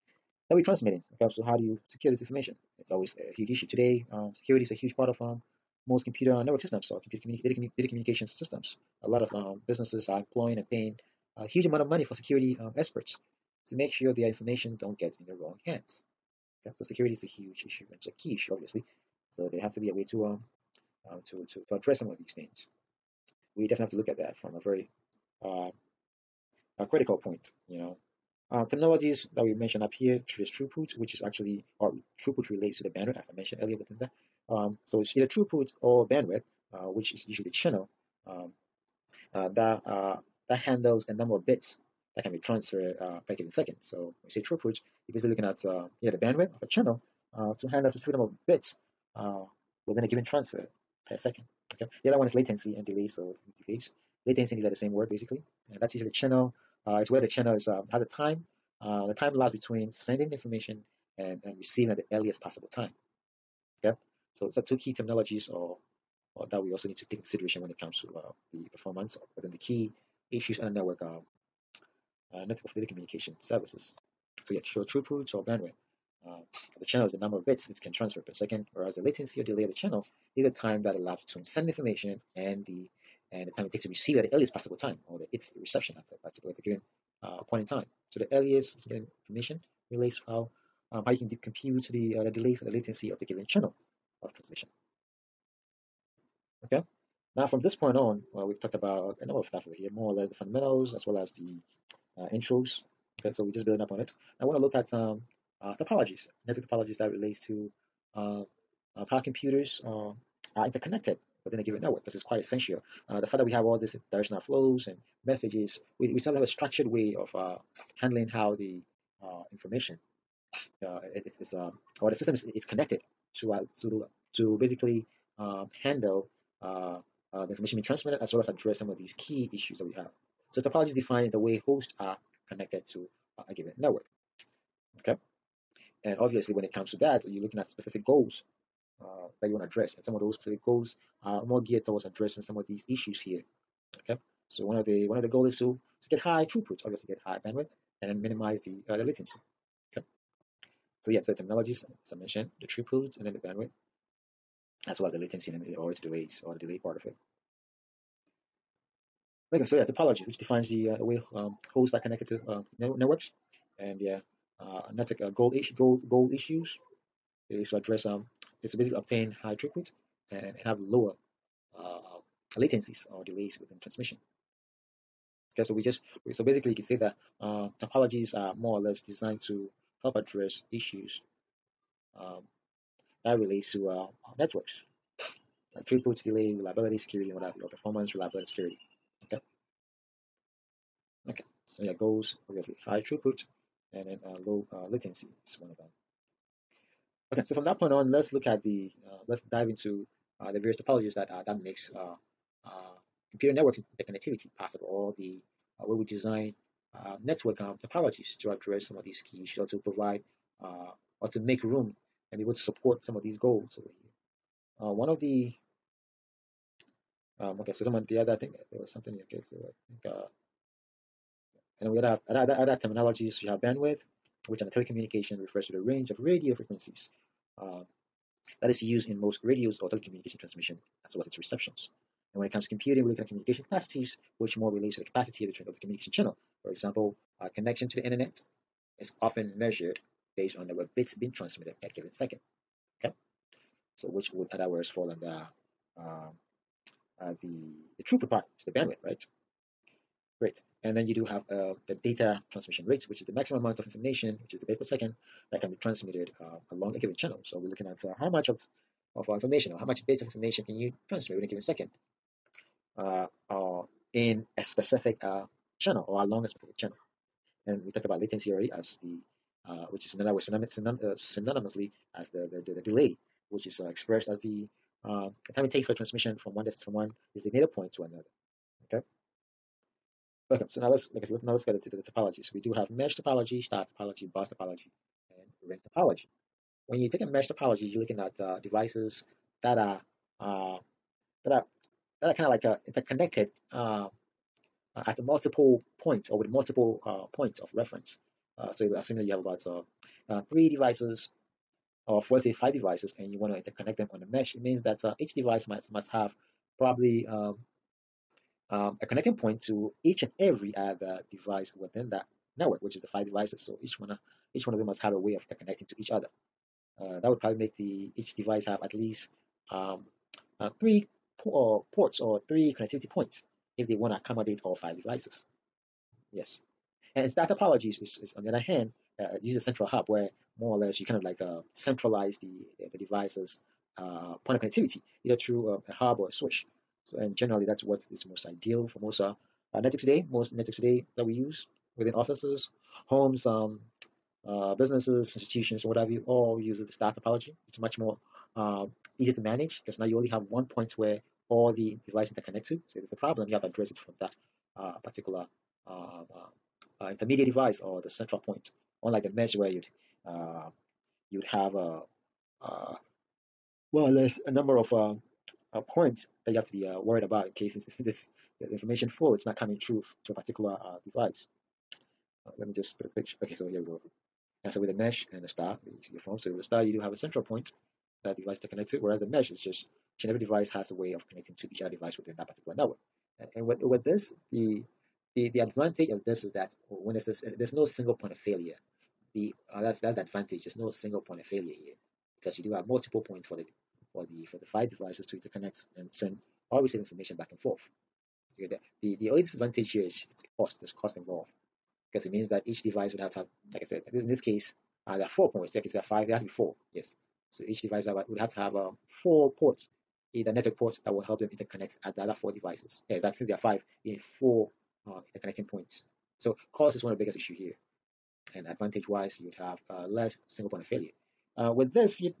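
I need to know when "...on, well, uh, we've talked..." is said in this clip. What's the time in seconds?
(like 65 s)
97 s.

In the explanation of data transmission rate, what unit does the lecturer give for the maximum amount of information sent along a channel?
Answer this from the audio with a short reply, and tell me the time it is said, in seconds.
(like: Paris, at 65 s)
bit per second, at 254 s.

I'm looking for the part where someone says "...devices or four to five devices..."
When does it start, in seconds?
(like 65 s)
300 s.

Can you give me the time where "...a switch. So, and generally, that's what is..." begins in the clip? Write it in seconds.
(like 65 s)
336 s.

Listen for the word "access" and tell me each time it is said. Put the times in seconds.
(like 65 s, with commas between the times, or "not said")
not said.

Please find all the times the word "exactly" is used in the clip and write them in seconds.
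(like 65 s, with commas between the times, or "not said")
413 s.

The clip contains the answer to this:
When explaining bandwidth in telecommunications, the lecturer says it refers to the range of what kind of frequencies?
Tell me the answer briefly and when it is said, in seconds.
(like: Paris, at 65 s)
radio frequencies, at 226 s.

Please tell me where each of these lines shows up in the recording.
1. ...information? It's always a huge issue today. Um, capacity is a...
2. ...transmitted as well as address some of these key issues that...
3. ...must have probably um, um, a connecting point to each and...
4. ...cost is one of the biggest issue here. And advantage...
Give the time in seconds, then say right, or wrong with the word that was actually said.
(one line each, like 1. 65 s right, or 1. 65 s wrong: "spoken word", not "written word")
1. 2 s wrong: "security", not "capacity"
2. 127 s right
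3. 305 s right
4. 416 s right.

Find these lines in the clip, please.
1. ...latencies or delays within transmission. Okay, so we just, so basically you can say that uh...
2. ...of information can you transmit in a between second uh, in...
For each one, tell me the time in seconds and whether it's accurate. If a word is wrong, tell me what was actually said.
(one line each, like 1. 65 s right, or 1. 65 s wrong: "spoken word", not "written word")
1. 172 s right
2. 260 s wrong: "given", not "between".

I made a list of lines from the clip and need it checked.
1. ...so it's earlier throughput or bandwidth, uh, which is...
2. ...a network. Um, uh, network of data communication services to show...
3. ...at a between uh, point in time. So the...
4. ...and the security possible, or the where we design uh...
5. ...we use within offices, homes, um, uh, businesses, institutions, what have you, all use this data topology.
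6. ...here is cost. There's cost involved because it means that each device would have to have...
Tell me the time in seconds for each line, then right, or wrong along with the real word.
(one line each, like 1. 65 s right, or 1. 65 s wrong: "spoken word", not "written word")
1. 34 s wrong: "either", not "earlier"
2. 70 s right
3. 86 s wrong: "given", not "between"
4. 203 s wrong: "connectivity", not "security"
5. 341 s right
6. 399 s right.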